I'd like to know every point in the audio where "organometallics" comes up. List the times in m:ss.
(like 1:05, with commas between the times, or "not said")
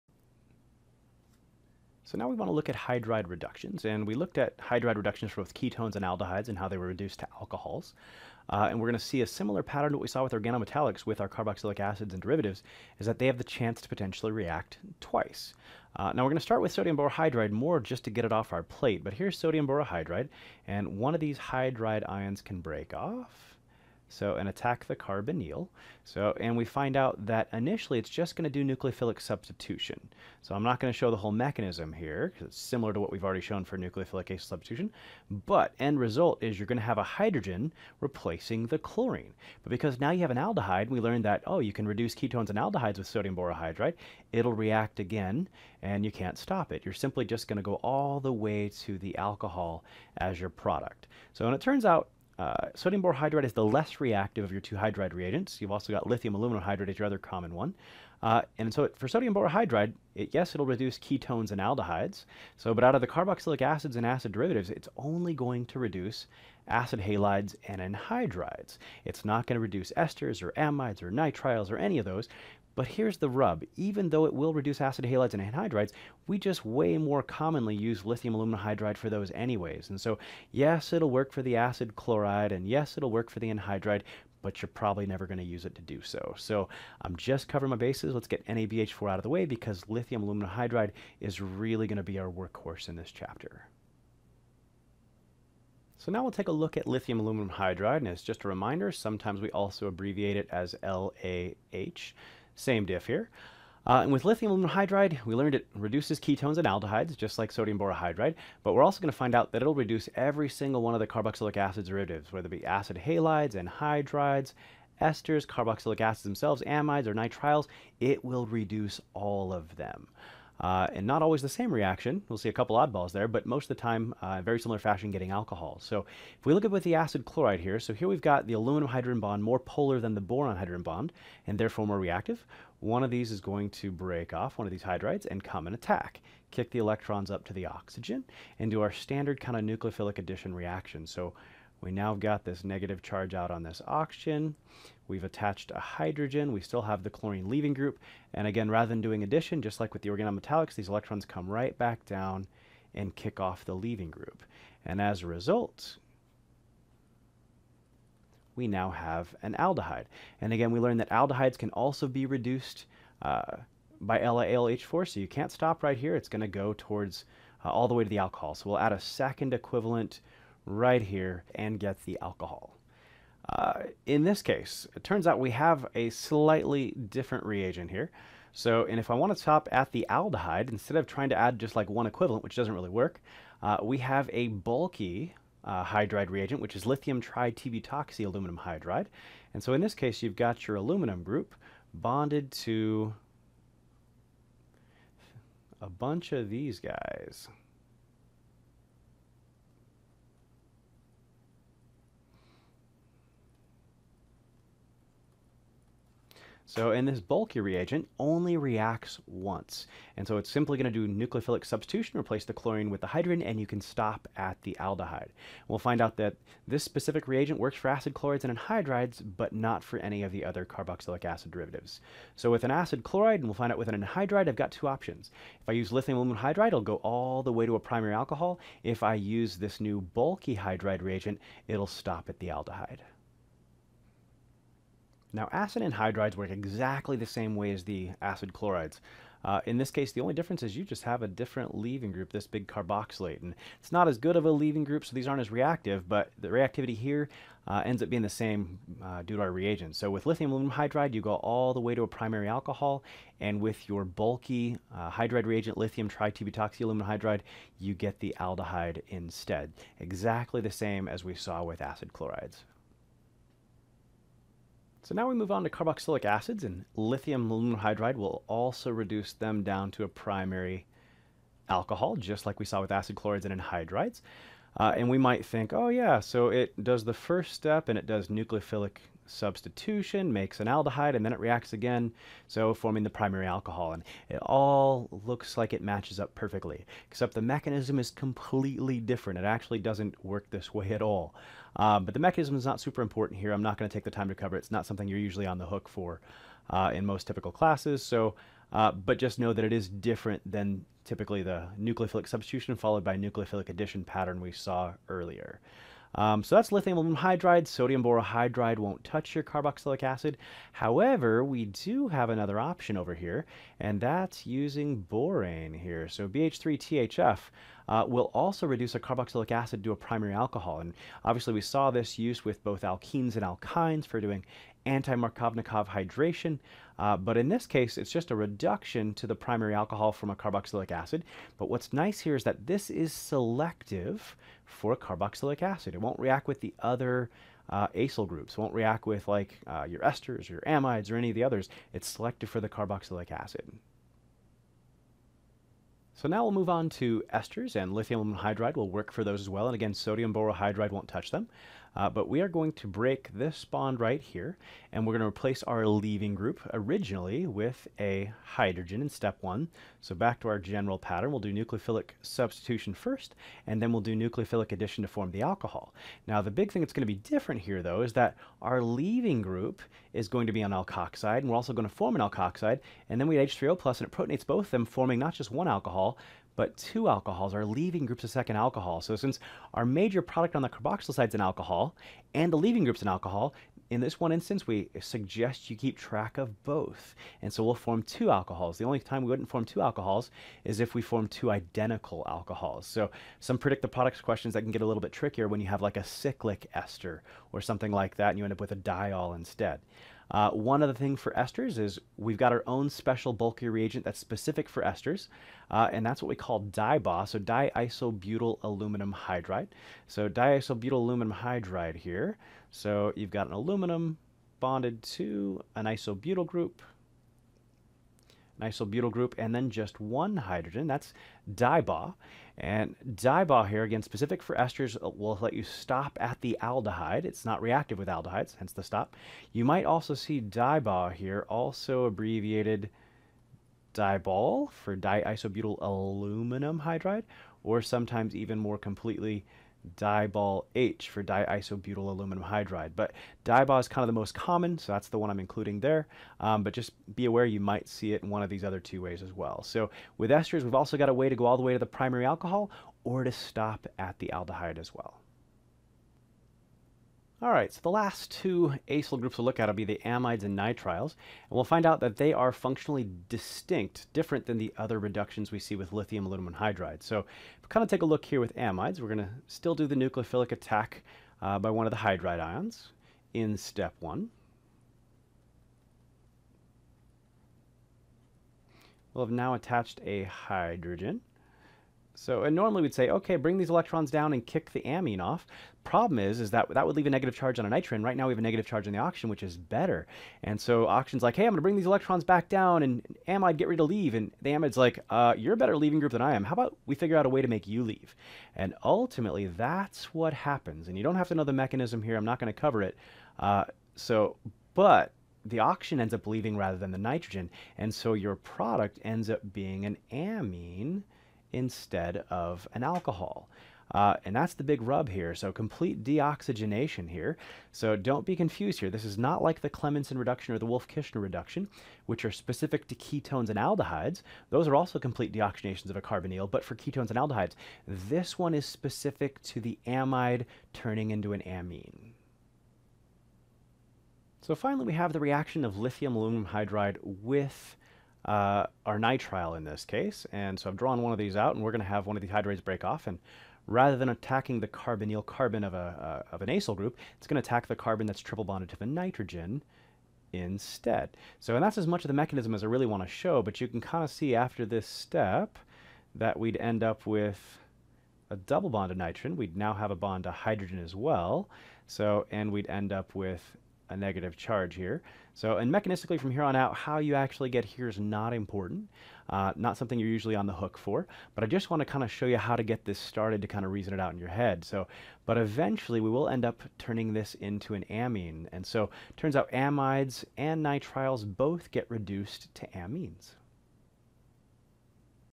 0:10, 2:30.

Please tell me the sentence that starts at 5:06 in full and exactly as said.
Um, so that's lithium aluminum hydride.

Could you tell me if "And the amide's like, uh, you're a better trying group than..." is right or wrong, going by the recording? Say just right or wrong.
wrong.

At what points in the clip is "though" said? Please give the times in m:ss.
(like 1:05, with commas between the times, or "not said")
1:14, 6:07.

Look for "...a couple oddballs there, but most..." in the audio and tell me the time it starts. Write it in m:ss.
2:02.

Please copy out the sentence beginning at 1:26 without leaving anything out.
So I'm just covering my bases.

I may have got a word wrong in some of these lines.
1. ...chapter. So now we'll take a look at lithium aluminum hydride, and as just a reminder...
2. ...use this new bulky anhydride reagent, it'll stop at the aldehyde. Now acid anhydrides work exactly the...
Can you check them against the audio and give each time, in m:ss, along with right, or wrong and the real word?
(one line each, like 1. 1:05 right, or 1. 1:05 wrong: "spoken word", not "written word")
1. 1:33 right
2. 3:49 wrong: "hydride", not "anhydride".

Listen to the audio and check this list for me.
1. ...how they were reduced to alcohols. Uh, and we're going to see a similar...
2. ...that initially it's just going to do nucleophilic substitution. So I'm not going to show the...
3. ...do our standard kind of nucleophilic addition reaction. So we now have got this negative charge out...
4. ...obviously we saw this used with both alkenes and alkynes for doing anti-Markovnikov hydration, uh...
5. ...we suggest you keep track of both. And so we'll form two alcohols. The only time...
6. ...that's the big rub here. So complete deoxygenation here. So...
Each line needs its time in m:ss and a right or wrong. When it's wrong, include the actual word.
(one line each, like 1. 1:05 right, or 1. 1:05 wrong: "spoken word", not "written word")
1. 0:06 right
2. 0:27 right
3. 2:18 right
4. 5:21 right
5. 6:24 right
6. 8:34 right.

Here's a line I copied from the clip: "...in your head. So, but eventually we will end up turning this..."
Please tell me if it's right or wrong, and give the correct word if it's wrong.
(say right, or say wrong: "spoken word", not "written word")
right.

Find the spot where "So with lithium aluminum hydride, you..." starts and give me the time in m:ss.
4:09.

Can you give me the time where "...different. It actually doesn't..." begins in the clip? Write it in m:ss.
4:48.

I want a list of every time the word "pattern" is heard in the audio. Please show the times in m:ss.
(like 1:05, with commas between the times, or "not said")
0:09, 5:04, 6:00.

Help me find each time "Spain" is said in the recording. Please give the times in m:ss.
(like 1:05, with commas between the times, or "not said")
not said.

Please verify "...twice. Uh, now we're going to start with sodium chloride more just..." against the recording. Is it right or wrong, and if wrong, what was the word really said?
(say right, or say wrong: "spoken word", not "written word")
wrong: "borohydride", not "chloride".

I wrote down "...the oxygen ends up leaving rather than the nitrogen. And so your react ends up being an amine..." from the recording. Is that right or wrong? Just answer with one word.
wrong.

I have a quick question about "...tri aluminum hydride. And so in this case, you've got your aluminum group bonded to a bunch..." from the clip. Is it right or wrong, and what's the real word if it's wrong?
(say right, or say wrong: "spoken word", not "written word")
right.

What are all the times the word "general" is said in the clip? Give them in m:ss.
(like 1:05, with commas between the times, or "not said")
6:00.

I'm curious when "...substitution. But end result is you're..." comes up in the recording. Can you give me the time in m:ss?
0:34.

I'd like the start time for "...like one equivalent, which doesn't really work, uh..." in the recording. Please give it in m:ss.
3:01.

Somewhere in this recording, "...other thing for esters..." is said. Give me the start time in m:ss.
6:40.